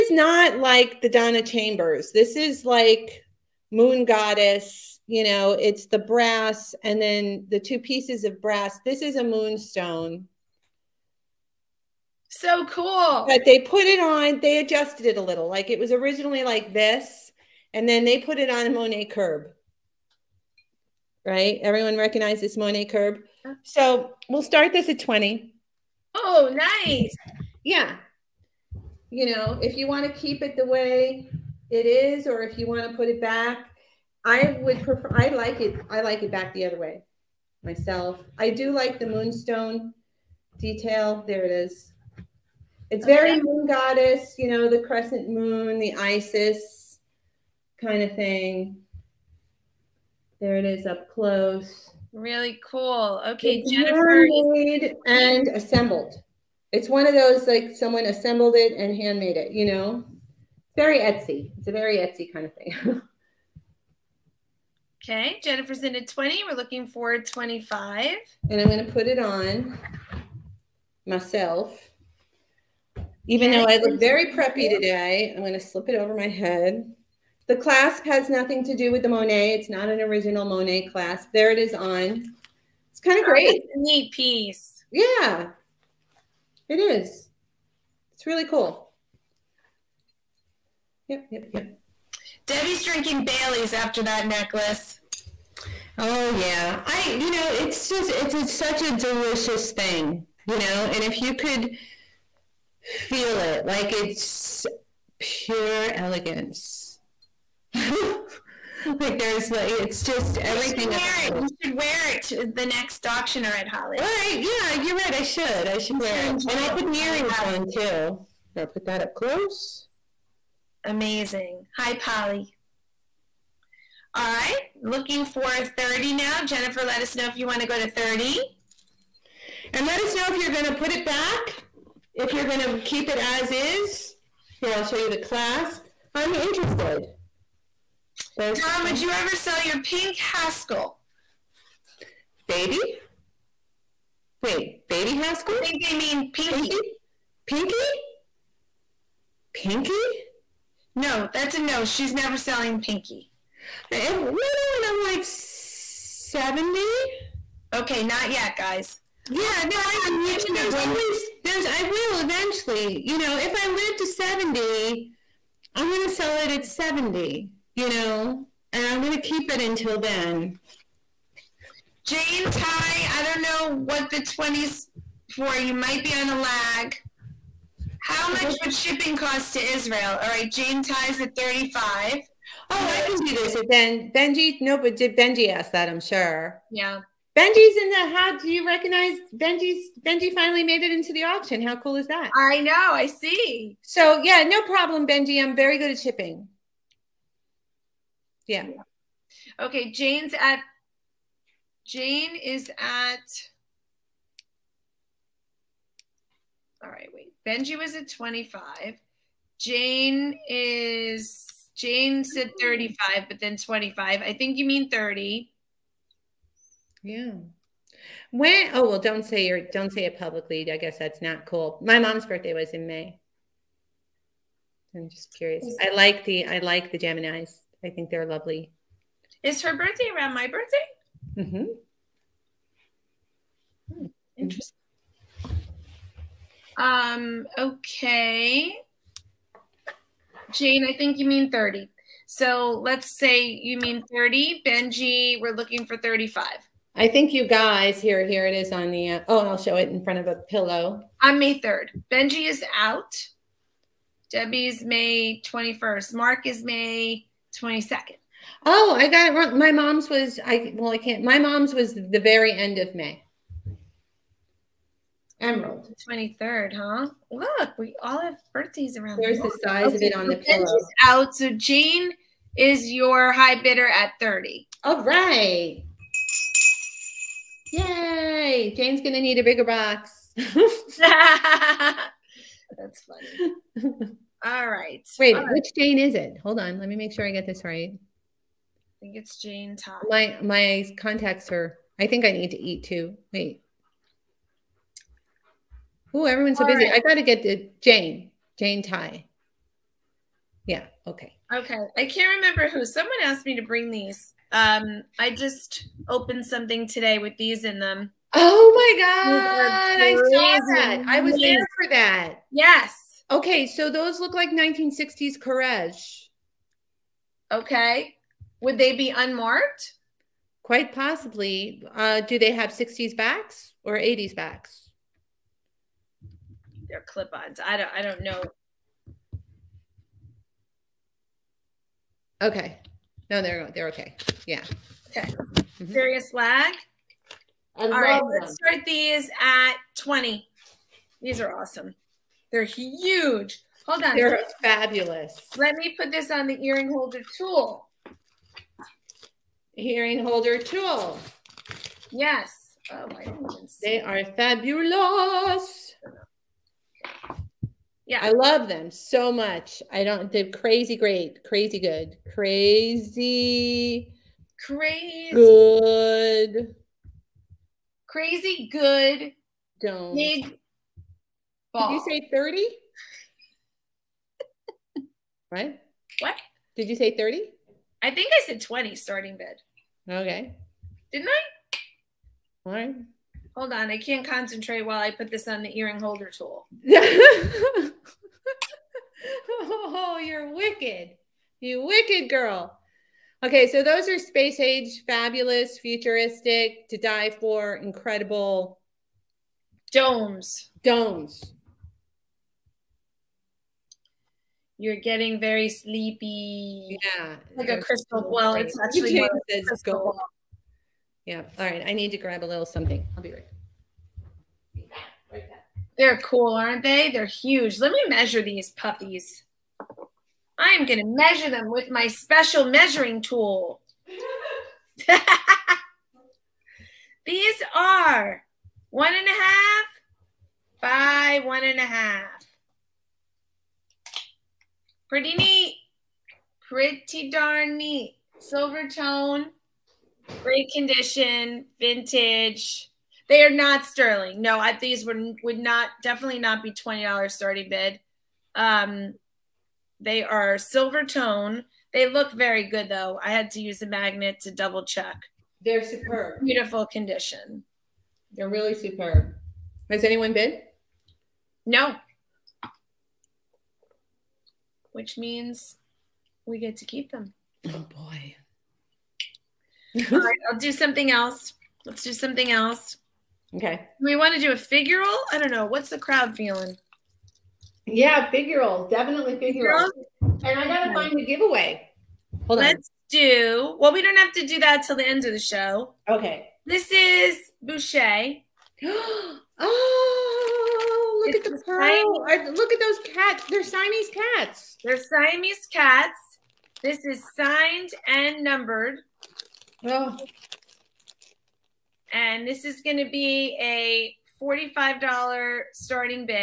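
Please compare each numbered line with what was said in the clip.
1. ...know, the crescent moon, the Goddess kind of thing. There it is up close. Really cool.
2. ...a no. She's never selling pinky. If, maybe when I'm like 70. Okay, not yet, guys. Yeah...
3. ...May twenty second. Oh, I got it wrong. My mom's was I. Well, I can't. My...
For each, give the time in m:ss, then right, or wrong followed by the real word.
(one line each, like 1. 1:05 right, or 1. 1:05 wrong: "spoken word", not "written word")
1. 0:44 wrong: "Isis", not "Goddess"
2. 2:31 right
3. 4:16 right.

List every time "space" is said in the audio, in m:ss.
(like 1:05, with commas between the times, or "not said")
6:34.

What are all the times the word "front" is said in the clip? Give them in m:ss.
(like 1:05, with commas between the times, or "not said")
4:10.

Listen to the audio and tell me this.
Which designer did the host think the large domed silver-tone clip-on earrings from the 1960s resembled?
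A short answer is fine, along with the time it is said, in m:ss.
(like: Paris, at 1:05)
Courrèges, at 5:15.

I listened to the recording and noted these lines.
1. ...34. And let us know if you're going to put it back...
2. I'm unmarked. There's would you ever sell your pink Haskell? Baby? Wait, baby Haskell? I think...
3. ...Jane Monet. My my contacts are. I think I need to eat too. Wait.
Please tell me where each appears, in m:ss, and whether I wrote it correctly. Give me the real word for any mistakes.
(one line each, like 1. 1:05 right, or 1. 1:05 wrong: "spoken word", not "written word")
1. 2:07 wrong: "30", not "34"
2. 2:16 wrong: "interested", not "unmarked"
3. 4:49 wrong: "Todd", not "Monet".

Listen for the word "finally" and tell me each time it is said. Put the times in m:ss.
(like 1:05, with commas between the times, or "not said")
3:10.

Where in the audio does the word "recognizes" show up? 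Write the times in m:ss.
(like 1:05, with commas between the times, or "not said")
0:21, 3:08.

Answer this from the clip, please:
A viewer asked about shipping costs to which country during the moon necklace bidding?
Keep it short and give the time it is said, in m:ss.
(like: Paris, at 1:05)
Israel, at 2:59.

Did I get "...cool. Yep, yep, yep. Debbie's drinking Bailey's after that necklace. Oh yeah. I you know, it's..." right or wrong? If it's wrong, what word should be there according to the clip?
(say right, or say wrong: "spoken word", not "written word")
right.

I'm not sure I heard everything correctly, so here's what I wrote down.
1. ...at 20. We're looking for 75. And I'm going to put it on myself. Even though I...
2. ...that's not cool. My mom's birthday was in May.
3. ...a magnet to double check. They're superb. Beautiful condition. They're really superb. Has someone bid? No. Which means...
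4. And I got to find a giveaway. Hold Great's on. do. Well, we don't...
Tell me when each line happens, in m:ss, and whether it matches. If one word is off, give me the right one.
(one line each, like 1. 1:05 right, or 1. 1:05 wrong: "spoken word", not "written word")
1. 1:05 wrong: "25", not "75"
2. 3:40 right
3. 7:33 wrong: "anyone", not "someone"
4. 8:00 wrong: "Let", not "Great".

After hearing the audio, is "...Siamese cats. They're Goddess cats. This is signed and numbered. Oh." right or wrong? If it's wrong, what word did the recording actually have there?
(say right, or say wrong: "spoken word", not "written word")
wrong: "Siamese", not "Goddess".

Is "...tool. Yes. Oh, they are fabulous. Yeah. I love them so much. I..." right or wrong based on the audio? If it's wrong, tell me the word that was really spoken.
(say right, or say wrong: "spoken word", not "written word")
right.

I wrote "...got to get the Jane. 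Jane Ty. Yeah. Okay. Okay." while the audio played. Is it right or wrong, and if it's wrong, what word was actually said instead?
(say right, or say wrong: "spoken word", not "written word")
right.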